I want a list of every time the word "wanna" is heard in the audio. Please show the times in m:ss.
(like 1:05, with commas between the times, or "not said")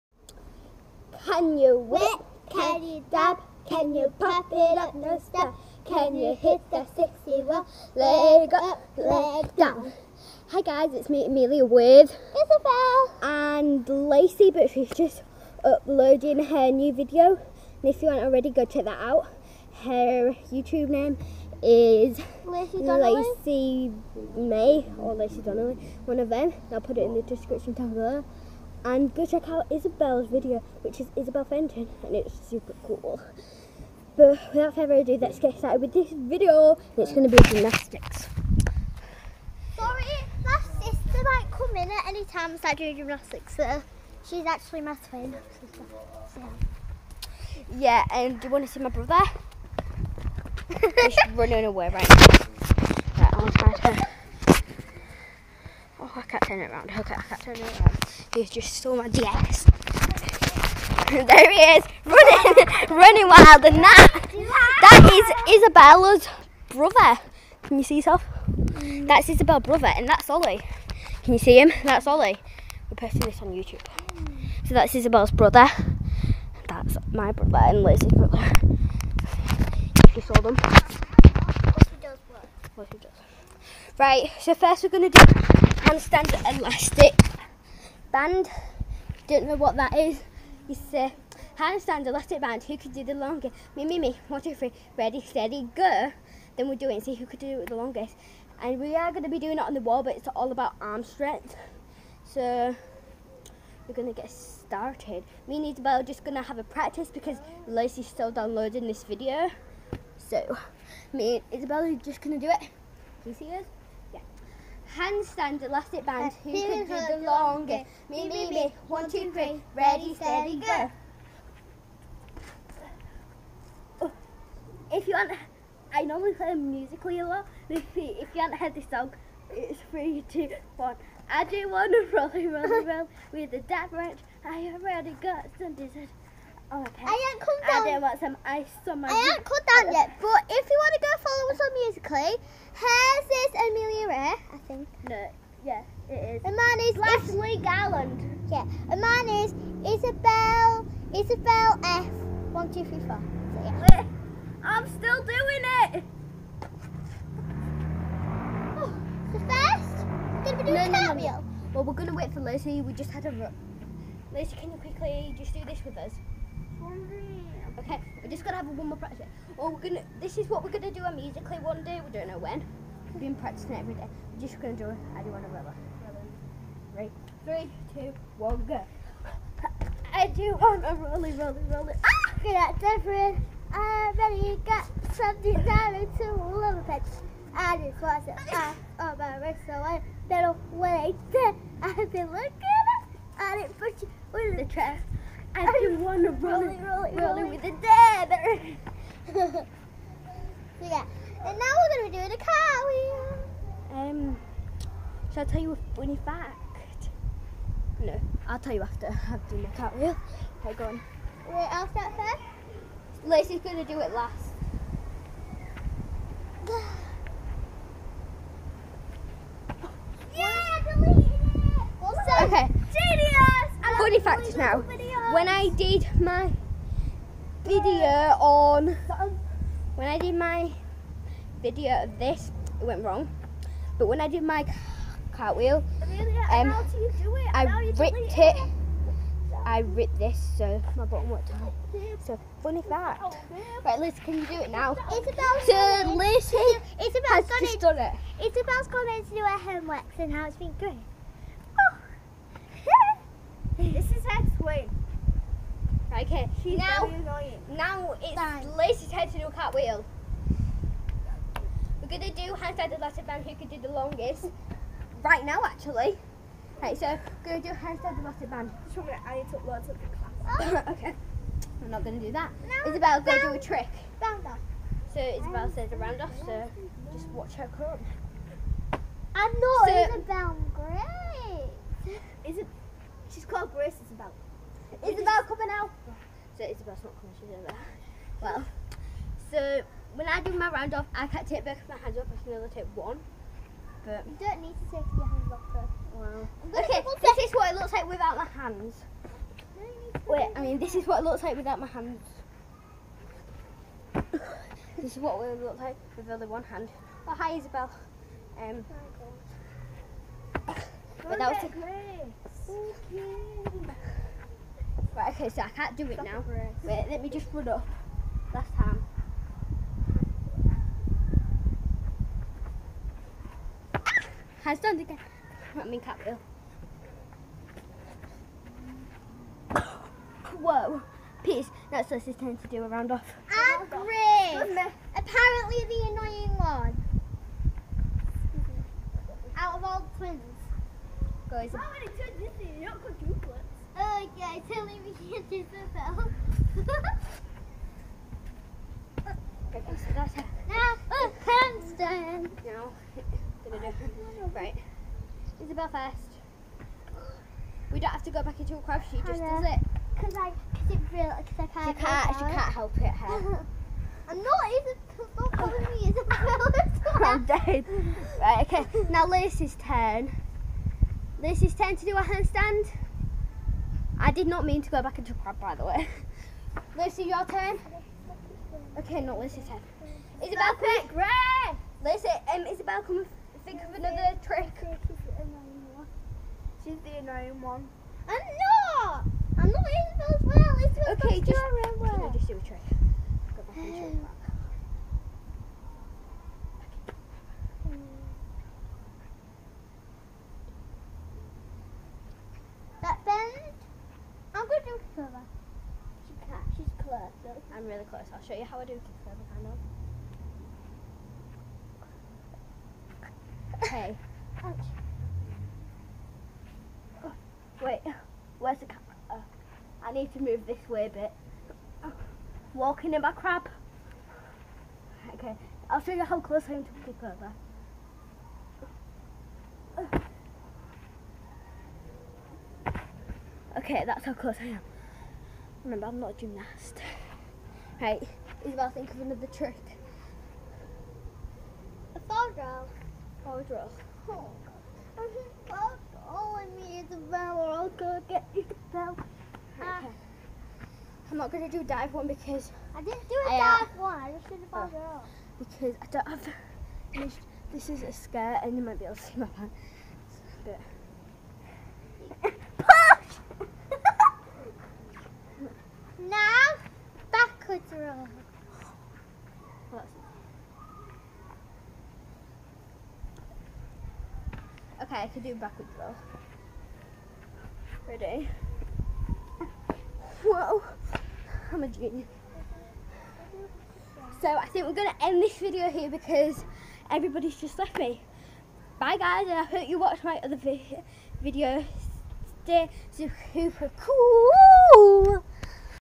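2:11, 2:20.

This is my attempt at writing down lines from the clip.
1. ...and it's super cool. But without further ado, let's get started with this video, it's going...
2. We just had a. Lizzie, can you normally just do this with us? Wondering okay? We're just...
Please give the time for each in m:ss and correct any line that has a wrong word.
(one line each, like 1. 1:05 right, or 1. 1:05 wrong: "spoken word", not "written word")
1. 0:32 right
2. 2:42 wrong: "quickly", not "normally".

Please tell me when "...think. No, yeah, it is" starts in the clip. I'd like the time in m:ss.
2:24.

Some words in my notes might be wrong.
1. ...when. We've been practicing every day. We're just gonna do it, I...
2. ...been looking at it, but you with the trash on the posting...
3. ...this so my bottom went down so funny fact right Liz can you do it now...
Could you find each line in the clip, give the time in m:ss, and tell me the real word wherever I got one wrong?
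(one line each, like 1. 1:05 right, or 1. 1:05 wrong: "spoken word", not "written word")
1. 2:52 right
2. 3:12 wrong: "rolling", not "posting"
3. 4:00 right.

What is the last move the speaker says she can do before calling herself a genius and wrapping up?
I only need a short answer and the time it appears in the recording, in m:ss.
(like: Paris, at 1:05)
backward throw, at 7:55.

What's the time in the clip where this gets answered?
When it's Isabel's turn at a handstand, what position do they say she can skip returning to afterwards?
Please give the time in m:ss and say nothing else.
5:58.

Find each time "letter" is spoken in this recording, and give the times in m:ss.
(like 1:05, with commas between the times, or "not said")
4:22, 4:28.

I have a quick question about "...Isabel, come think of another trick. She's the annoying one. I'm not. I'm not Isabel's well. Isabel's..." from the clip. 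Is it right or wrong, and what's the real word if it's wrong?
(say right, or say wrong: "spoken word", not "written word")
right.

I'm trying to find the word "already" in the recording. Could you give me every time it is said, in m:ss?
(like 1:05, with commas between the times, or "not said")
0:18, 2:14, 3:04.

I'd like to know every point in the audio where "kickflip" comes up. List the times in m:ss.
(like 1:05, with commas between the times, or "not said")
6:48, 7:07.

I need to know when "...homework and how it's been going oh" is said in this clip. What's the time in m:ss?
4:09.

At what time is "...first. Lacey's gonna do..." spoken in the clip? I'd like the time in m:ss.
3:32.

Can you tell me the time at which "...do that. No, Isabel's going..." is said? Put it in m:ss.
4:32.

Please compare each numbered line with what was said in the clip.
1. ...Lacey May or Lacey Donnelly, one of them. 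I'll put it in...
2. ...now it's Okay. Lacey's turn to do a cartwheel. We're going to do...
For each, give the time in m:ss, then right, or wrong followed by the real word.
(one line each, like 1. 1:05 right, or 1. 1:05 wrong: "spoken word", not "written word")
1. 0:22 right
2. 4:17 wrong: "Bye", not "Okay".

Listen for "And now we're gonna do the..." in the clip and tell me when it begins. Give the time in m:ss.
3:21.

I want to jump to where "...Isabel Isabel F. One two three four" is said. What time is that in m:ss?
2:29.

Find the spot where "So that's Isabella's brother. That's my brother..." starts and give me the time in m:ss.
1:14.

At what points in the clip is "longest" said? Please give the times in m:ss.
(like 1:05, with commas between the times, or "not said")
1:33, 1:37, 1:57, 4:23.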